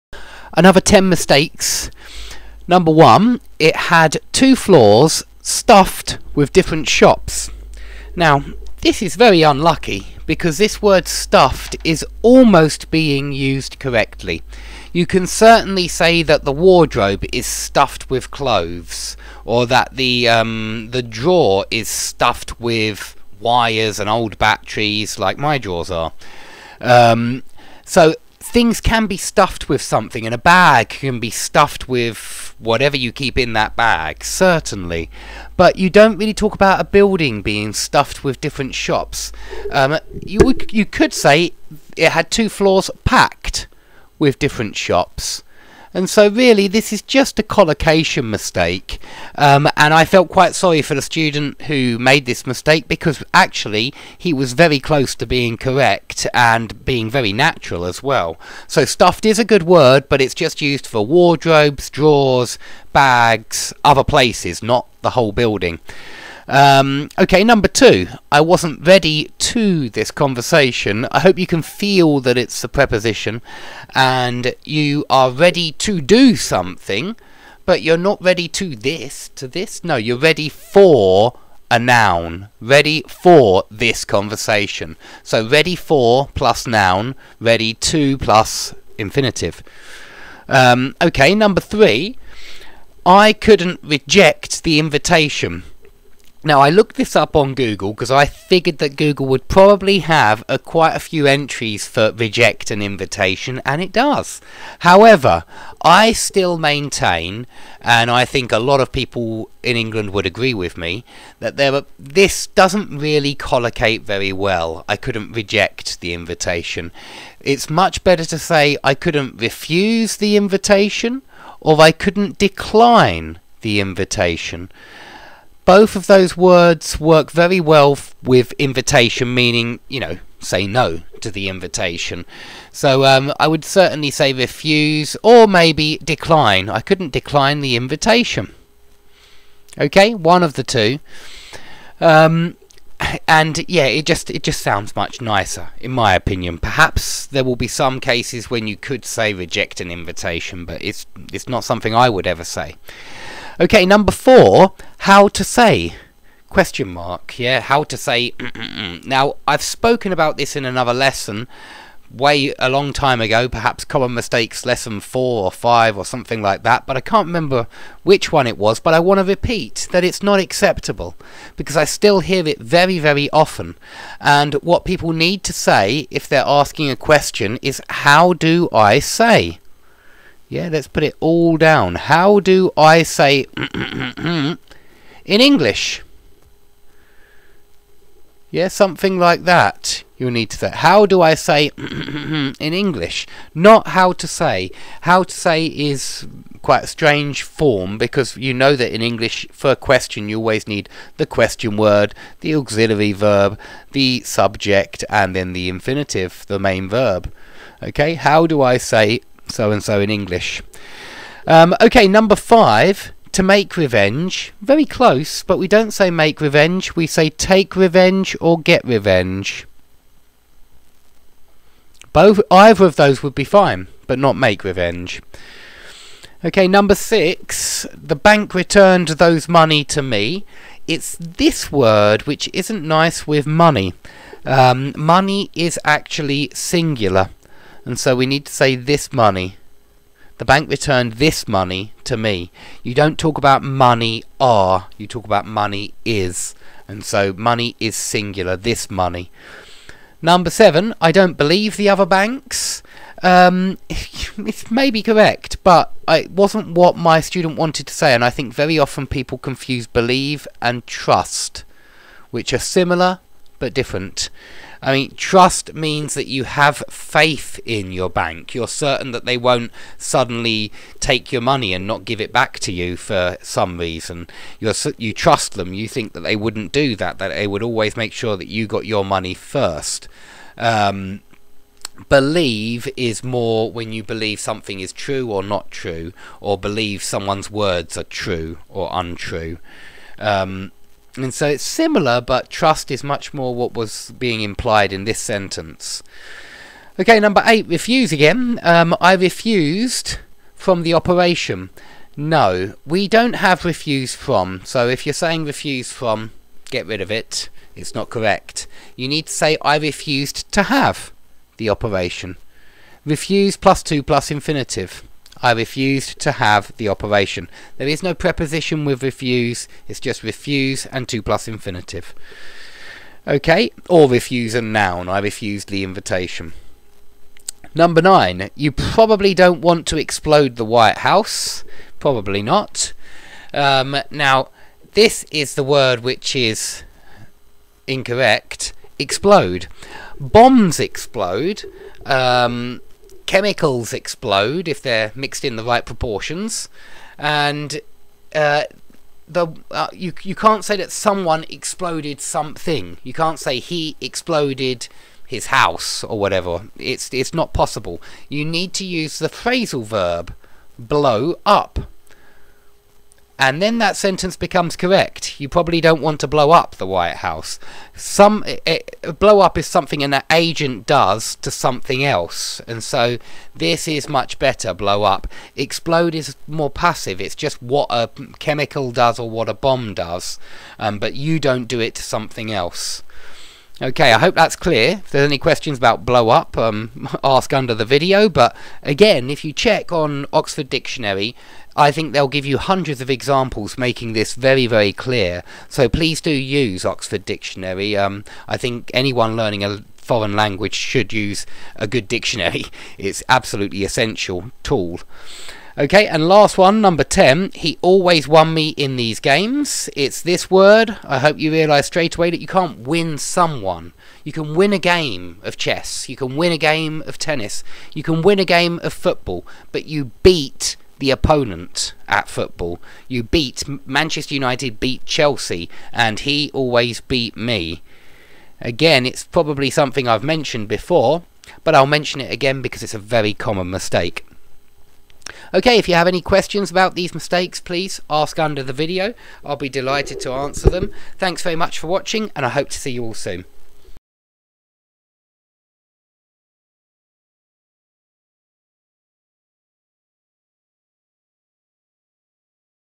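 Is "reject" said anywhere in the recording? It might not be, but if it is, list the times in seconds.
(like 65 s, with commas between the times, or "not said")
93 s, 102 s, 115 s, 149 s.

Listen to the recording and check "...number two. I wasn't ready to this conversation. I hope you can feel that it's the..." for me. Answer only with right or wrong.
right.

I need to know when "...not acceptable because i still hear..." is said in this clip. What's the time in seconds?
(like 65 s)
170 s.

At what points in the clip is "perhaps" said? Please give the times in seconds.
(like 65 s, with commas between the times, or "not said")
146 s, 163 s.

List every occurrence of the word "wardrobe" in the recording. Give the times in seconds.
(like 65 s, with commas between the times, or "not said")
16 s, 61 s.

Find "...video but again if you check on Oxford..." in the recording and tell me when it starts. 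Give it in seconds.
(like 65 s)
387 s.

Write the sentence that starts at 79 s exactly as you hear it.
No, you're ready for a noun.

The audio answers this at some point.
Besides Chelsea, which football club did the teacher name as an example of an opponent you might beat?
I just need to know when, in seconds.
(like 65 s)
423 s.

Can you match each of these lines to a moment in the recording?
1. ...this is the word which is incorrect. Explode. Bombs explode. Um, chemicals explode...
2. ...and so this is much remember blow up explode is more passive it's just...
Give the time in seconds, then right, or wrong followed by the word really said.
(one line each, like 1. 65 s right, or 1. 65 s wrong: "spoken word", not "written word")
1. 334 s right
2. 372 s wrong: "better", not "remember".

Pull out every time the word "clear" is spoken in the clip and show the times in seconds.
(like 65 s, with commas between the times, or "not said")
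384 s, 394 s.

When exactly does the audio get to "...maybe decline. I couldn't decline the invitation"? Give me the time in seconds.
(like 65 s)
135 s.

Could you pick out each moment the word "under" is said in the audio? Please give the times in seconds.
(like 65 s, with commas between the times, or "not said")
387 s, 438 s.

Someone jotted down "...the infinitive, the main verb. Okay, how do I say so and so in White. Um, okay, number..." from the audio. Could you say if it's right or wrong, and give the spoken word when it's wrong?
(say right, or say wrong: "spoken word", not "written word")
wrong: "English", not "White".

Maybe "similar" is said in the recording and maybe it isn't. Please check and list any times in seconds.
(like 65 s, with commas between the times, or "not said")
262 s, 291 s.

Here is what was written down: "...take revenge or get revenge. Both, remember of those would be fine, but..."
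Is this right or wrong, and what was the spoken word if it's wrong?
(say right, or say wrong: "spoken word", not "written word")
wrong: "either", not "remember".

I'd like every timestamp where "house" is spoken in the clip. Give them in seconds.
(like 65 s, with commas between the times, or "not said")
330 s, 355 s, 367 s.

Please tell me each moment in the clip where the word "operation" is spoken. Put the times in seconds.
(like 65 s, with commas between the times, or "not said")
300 s, 311 s, 316 s.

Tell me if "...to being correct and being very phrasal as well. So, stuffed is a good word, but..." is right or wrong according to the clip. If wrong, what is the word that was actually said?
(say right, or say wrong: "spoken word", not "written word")
wrong: "natural", not "phrasal".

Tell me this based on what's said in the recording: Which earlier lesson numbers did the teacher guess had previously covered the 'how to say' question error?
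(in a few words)
4 or 5.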